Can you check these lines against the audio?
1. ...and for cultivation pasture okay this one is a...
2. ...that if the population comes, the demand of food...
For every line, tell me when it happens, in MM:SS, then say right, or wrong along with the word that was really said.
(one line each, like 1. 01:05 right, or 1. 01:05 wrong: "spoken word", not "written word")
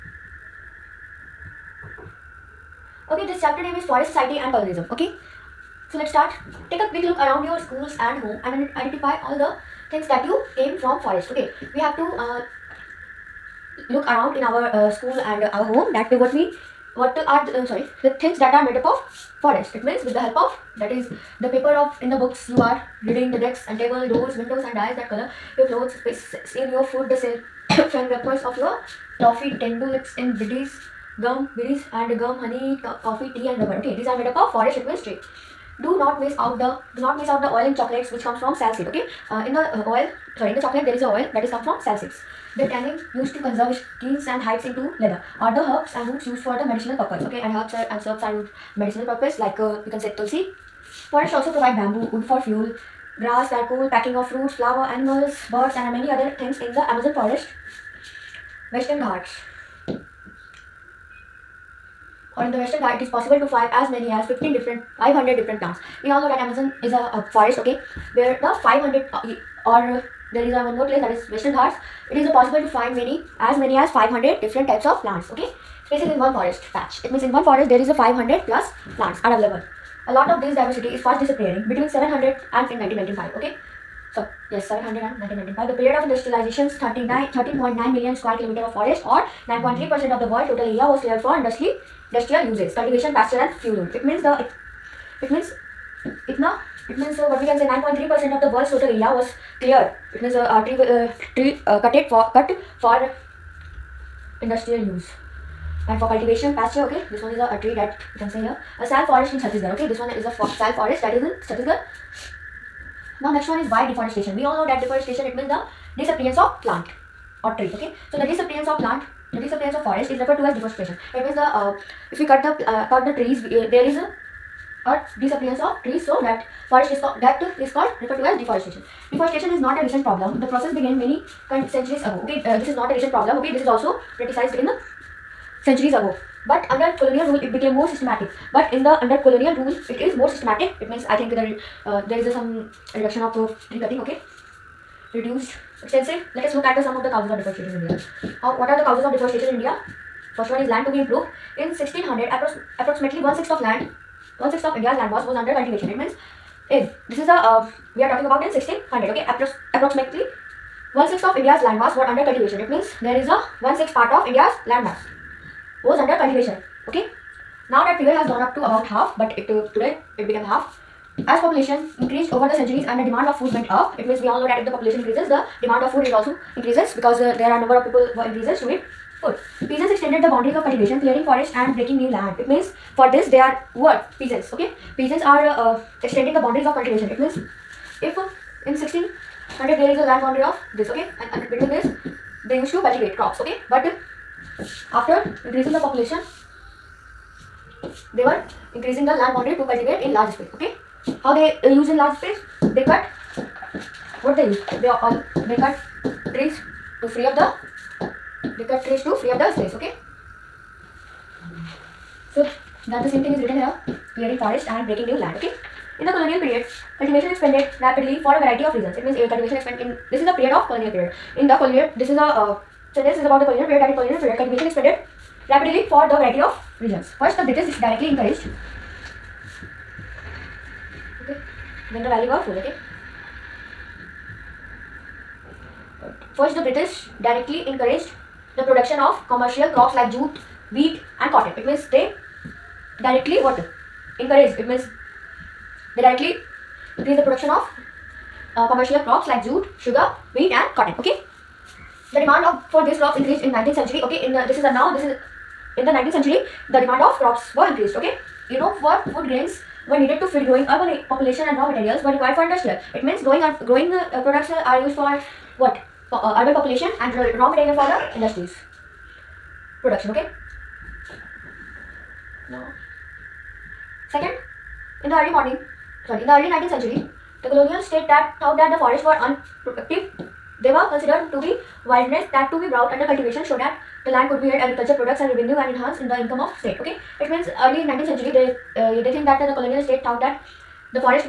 1. 01:45 right
2. 02:54 wrong: "increases", not "comes".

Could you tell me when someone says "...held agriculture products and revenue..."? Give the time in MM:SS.
04:44.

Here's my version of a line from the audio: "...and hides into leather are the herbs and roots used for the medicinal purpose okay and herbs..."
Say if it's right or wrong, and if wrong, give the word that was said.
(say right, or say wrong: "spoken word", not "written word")
right.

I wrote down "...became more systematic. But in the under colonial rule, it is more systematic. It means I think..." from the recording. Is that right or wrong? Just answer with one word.
right.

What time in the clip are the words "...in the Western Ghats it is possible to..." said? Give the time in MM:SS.
01:02.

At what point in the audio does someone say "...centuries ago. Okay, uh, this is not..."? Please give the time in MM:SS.
02:11.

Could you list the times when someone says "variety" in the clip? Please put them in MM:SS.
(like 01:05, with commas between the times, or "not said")
03:38, 03:46.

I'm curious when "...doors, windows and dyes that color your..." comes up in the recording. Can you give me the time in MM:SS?
00:24.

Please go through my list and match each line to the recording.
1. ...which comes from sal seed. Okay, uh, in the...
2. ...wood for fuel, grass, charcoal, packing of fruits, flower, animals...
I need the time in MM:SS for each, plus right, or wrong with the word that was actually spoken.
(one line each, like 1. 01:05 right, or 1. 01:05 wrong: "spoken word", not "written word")
1. 00:38 right
2. 00:52 right.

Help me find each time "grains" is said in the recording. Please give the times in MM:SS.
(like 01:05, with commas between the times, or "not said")
04:19.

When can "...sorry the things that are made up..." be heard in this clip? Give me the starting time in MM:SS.
00:17.